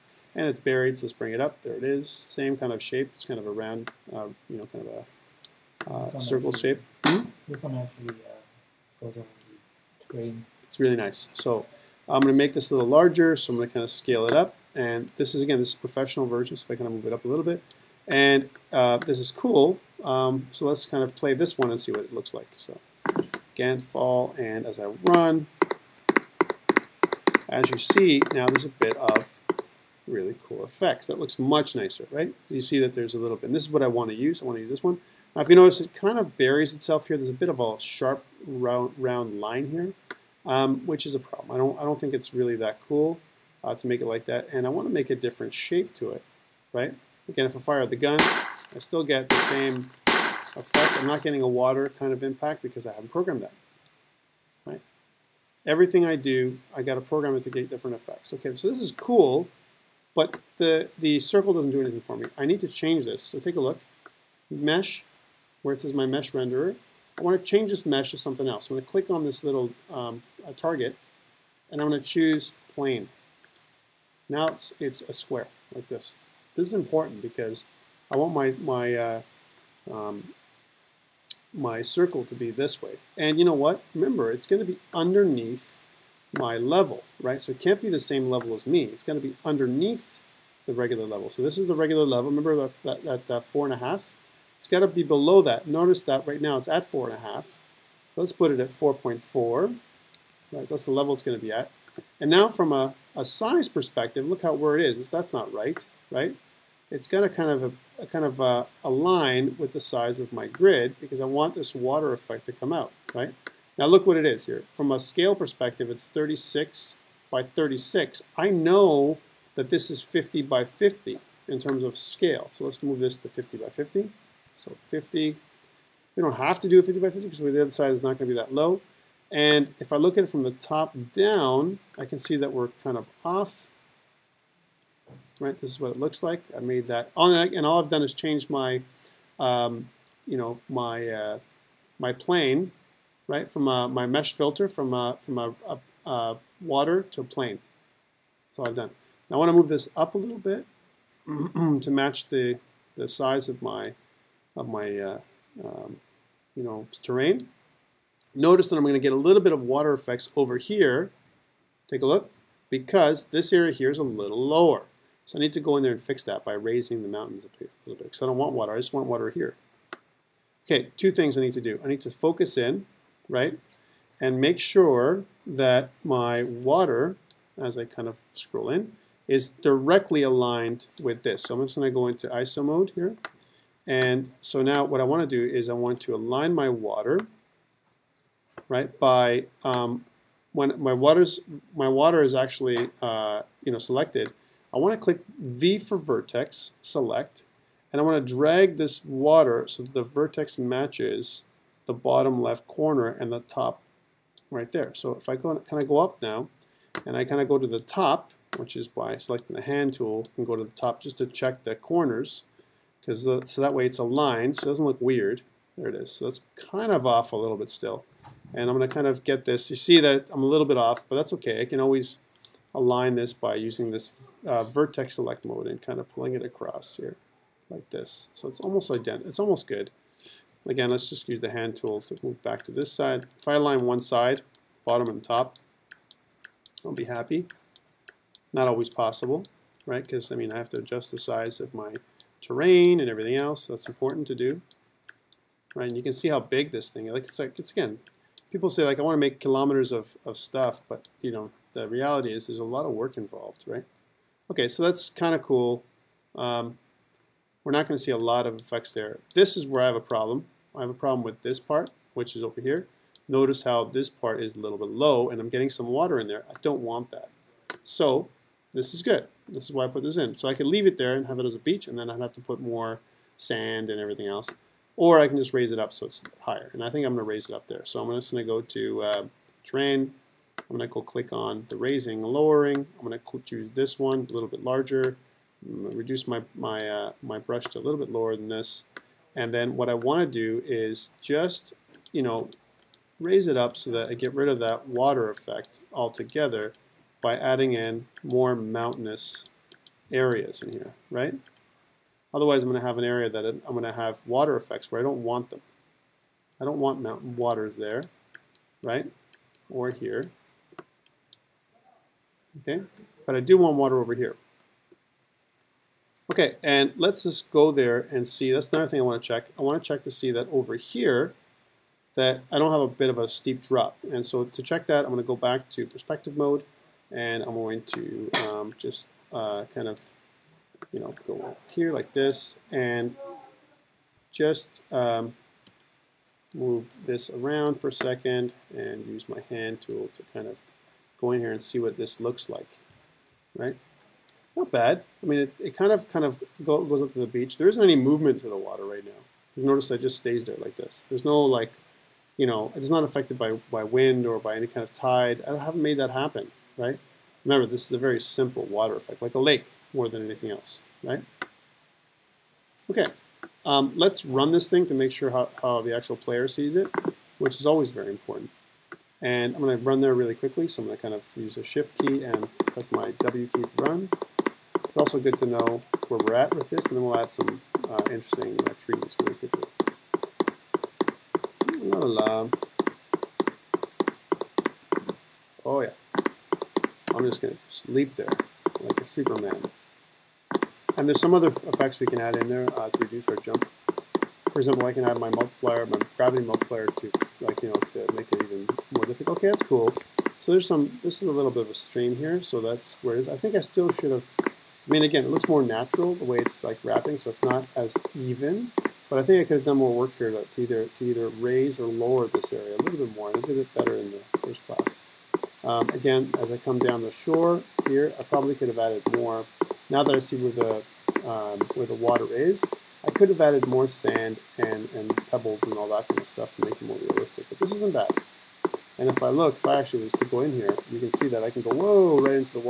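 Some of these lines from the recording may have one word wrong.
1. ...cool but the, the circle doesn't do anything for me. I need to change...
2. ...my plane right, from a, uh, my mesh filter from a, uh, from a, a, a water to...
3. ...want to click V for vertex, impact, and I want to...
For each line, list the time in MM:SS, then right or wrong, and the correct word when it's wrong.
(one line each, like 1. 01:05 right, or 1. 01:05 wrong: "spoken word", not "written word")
1. 00:58 right
2. 02:21 right
3. 03:14 wrong: "select", not "impact".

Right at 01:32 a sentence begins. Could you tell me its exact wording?
Remember that, that, that four and a half?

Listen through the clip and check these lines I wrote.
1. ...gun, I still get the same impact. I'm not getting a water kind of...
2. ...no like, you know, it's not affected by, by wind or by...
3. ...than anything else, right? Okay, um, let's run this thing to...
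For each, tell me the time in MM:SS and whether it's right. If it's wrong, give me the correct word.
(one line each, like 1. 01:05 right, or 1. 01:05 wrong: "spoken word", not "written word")
1. 00:47 wrong: "effect", not "impact"
2. 05:51 right
3. 06:00 right.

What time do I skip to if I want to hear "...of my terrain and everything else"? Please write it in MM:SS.
04:01.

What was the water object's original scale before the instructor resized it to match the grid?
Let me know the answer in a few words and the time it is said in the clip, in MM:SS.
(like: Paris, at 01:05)
36 by 36, at 01:56.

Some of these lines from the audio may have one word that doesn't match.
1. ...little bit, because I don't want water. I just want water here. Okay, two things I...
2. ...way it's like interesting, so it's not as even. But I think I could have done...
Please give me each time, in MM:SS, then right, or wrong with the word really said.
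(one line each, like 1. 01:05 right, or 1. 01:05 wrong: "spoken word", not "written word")
1. 02:47 right
2. 06:46 wrong: "wrapping", not "interesting".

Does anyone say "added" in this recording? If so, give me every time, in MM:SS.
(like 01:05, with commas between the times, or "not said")
06:58, 07:03.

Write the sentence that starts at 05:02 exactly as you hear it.
Otherwise, I'm going to have an area that I'm going to have water effects where I don't want them.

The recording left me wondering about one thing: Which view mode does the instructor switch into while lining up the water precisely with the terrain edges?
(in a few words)
ISO mode.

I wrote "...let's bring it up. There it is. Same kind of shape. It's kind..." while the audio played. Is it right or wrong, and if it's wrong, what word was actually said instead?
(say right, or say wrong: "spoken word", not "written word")
right.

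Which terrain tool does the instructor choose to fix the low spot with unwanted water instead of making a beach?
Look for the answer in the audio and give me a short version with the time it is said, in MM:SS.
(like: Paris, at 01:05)
raising, lowering, at 04:41.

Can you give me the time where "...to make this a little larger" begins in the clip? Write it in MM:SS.
00:12.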